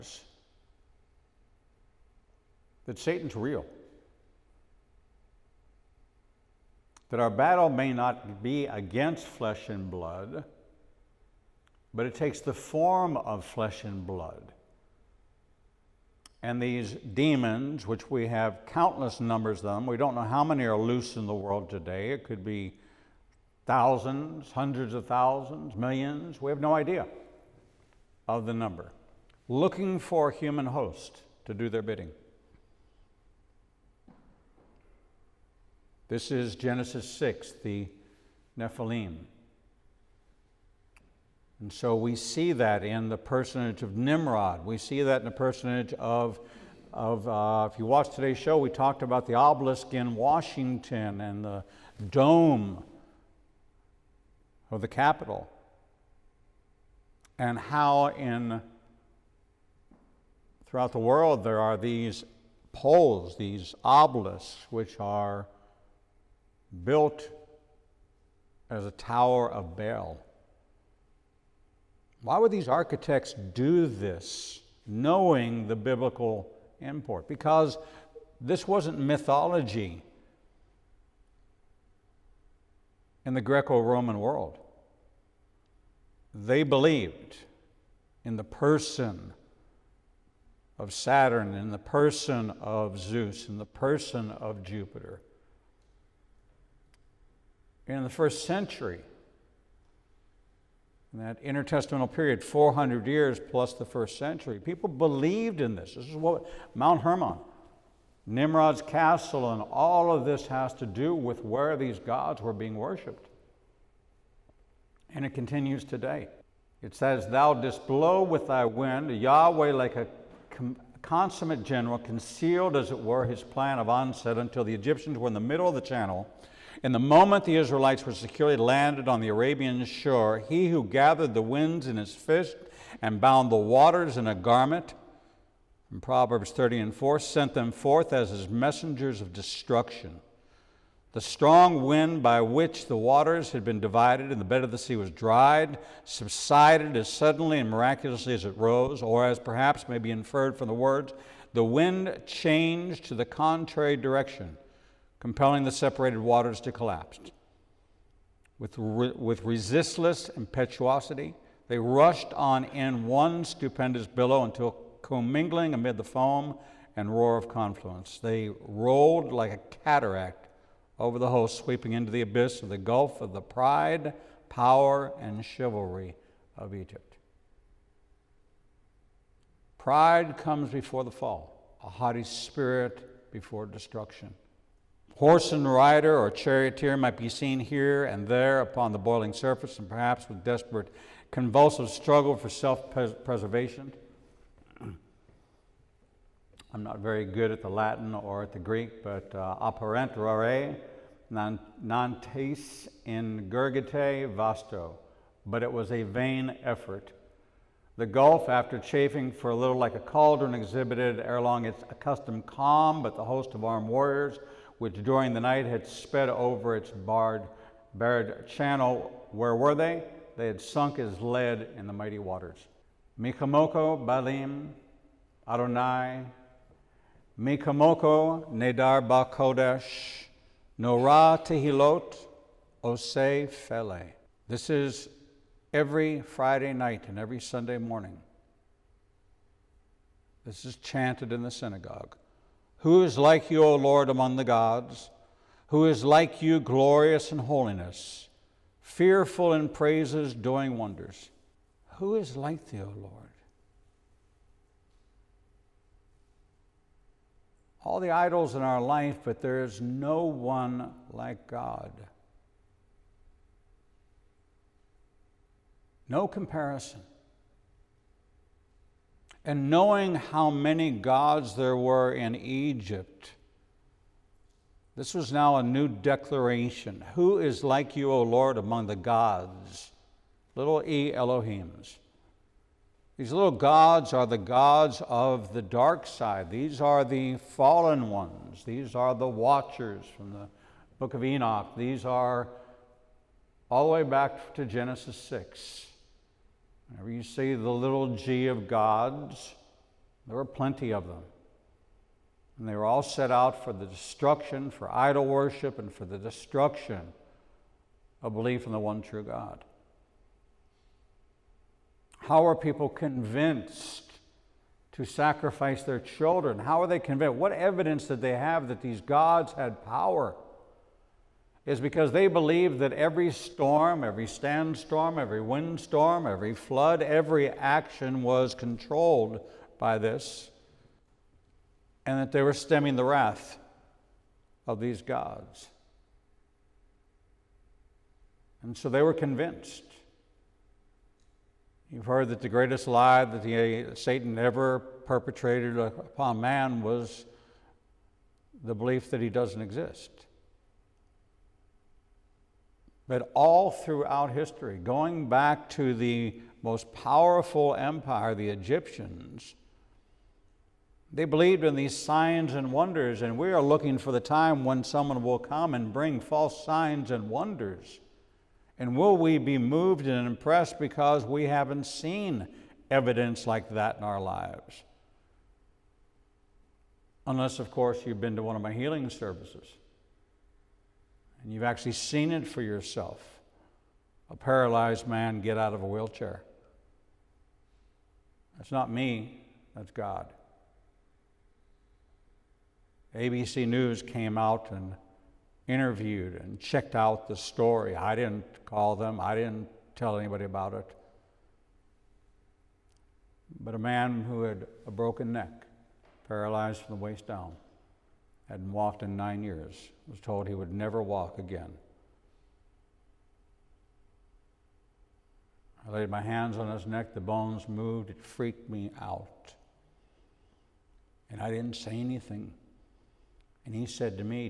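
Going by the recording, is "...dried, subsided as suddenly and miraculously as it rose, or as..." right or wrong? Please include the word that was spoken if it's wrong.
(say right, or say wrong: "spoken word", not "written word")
right.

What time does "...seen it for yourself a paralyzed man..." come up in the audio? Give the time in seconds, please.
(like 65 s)
381 s.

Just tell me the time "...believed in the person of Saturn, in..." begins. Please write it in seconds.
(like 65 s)
86 s.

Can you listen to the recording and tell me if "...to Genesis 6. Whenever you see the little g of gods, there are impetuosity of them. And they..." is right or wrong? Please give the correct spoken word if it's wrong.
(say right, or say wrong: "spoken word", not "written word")
wrong: "plenty", not "impetuosity".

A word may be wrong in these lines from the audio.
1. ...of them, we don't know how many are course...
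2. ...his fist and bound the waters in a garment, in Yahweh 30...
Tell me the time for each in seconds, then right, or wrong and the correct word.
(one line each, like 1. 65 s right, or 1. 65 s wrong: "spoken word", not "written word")
1. 19 s wrong: "loose", not "course"
2. 131 s wrong: "Proverbs", not "Yahweh".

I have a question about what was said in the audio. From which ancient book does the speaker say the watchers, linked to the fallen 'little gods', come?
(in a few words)
Book of Enoch.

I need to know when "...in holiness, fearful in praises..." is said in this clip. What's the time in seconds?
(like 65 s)
247 s.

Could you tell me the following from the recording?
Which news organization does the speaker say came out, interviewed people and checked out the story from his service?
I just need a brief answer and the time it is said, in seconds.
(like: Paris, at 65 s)
ABC News, at 393 s.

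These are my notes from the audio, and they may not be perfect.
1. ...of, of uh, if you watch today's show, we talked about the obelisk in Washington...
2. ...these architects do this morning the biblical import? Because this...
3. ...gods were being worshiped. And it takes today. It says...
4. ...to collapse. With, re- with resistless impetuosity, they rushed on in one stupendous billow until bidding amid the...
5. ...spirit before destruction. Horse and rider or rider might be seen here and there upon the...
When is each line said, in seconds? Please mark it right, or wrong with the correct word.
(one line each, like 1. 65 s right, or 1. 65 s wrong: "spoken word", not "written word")
1. 45 s right
2. 72 s wrong: "knowing", not "morning"
3. 111 s wrong: "continues", not "takes"
4. 156 s wrong: "commingling", not "bidding"
5. 182 s wrong: "charioteer", not "rider".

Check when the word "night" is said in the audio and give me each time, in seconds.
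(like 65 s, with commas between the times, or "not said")
215 s, 236 s.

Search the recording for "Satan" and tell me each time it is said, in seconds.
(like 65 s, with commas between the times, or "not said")
2 s, 343 s.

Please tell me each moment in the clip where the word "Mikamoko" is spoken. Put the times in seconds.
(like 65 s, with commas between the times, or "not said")
223 s, 227 s.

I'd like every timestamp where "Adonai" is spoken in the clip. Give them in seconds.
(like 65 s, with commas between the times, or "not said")
225 s.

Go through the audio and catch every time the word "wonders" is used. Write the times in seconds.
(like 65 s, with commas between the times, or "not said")
250 s, 362 s, 367 s.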